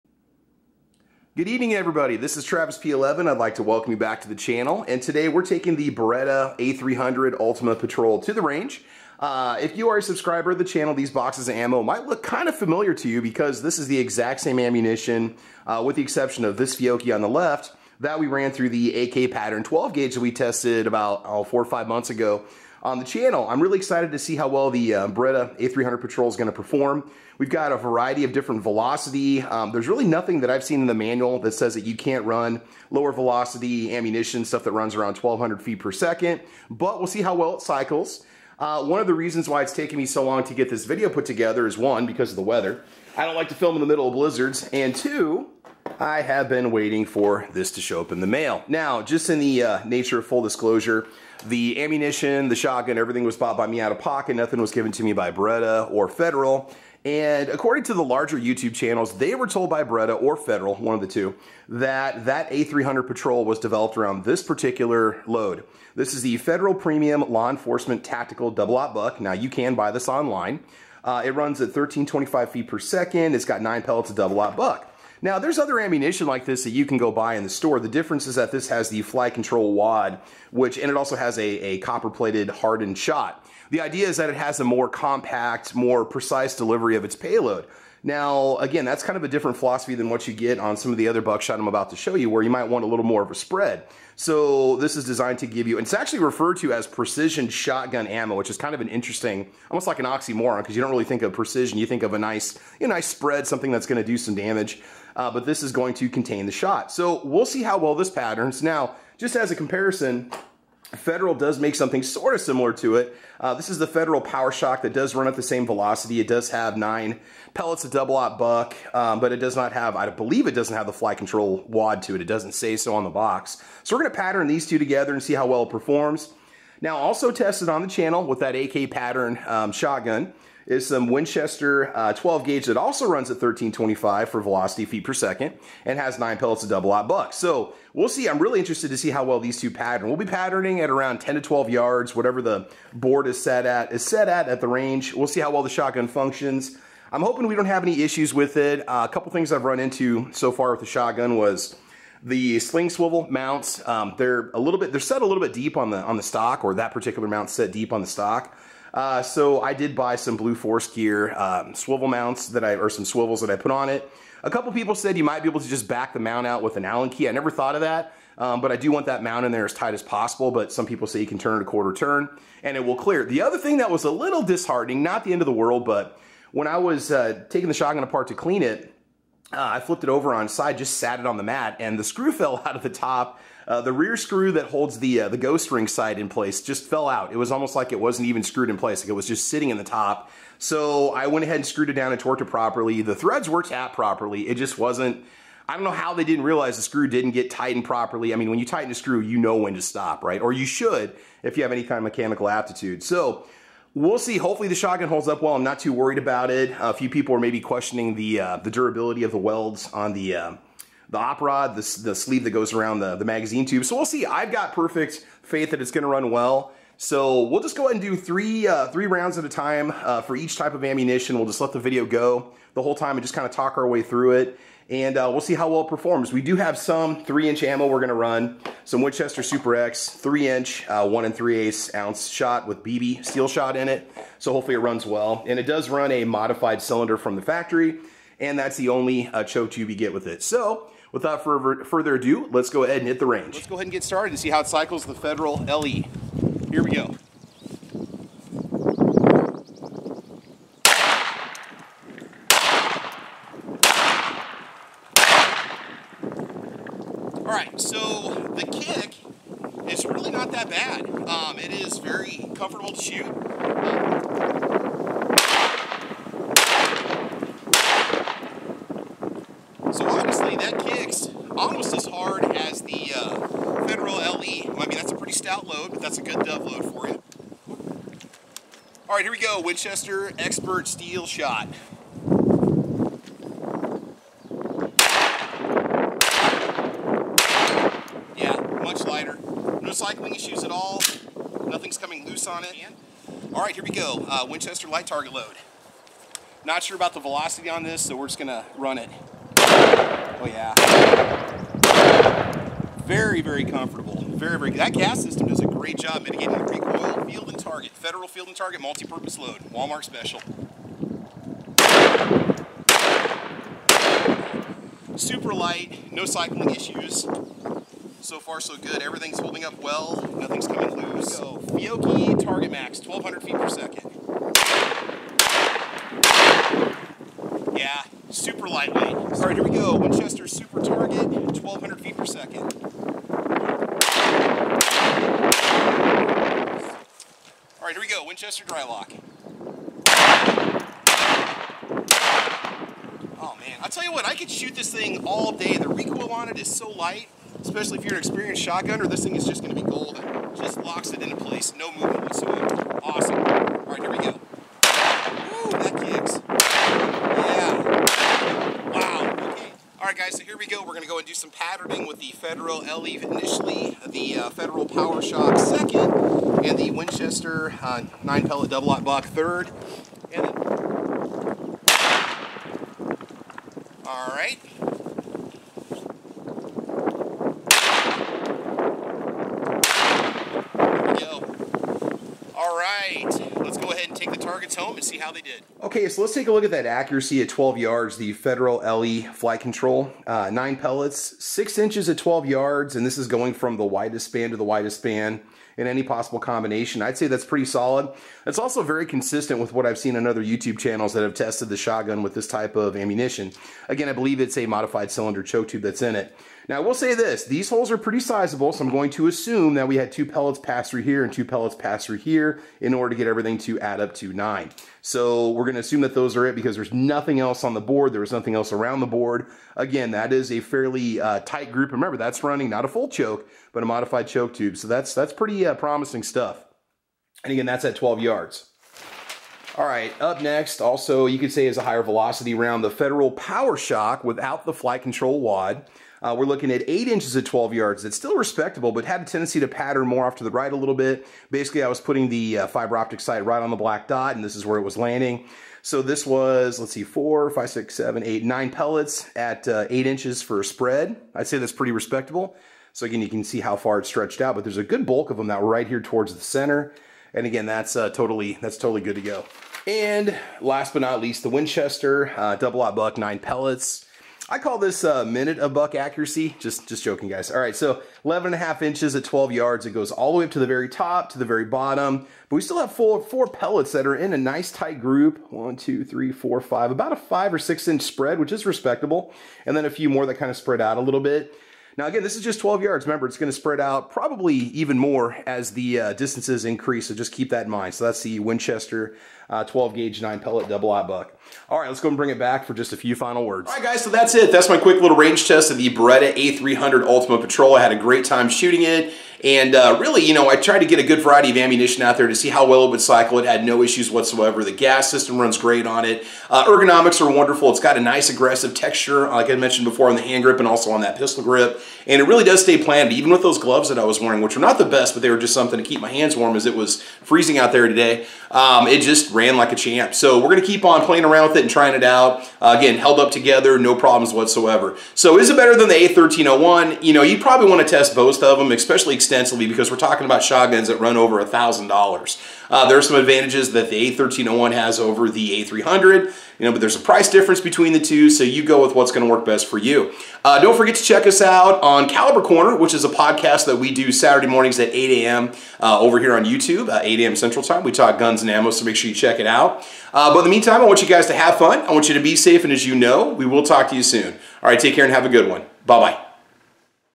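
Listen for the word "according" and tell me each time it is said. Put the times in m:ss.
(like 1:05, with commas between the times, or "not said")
0:57.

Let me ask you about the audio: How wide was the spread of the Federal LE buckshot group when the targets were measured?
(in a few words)
6 inches.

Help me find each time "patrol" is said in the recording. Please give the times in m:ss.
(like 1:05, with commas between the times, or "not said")
0:07, 0:26, 1:03, 8:17.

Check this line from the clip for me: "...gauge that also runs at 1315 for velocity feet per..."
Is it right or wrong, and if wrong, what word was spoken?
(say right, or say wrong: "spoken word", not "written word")
wrong: "1325", not "1315".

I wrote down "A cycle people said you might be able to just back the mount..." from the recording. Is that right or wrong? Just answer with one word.
wrong.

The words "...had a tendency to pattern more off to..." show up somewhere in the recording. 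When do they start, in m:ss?
7:19.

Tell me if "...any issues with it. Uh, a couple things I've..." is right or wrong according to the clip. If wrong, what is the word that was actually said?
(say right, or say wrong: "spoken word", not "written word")
right.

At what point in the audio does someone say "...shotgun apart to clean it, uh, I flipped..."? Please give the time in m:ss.
2:57.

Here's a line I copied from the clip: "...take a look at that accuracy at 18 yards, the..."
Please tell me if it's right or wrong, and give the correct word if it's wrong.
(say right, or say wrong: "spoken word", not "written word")
wrong: "12", not "18".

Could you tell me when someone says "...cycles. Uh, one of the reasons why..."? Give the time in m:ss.
0:37.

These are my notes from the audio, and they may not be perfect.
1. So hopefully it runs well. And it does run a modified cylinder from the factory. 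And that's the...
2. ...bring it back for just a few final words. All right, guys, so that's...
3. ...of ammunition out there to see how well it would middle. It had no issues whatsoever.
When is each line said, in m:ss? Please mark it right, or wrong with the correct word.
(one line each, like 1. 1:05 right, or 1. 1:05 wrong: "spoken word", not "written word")
1. 3:54 right
2. 8:12 right
3. 8:21 wrong: "cycle", not "middle".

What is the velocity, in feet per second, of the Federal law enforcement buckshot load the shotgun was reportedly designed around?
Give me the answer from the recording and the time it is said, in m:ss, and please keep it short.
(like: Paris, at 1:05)
1325, at 1:11.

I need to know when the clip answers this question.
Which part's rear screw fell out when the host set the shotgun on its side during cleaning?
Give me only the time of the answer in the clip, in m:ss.
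3:05.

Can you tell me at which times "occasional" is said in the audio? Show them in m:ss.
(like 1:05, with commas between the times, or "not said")
not said.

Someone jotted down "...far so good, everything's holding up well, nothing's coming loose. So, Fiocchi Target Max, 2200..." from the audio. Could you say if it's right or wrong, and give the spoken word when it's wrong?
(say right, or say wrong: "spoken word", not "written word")
wrong: "1200", not "2200".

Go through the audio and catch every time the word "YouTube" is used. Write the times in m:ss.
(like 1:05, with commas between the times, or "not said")
0:58, 6:40, 9:06.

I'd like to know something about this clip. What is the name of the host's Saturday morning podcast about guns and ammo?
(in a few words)
Caliber Corner.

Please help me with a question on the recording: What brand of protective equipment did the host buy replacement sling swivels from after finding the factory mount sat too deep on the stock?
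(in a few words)
Blue Force Gear.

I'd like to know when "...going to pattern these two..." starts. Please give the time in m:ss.
2:04.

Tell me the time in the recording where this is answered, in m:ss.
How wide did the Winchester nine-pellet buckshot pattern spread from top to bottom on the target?
7:48.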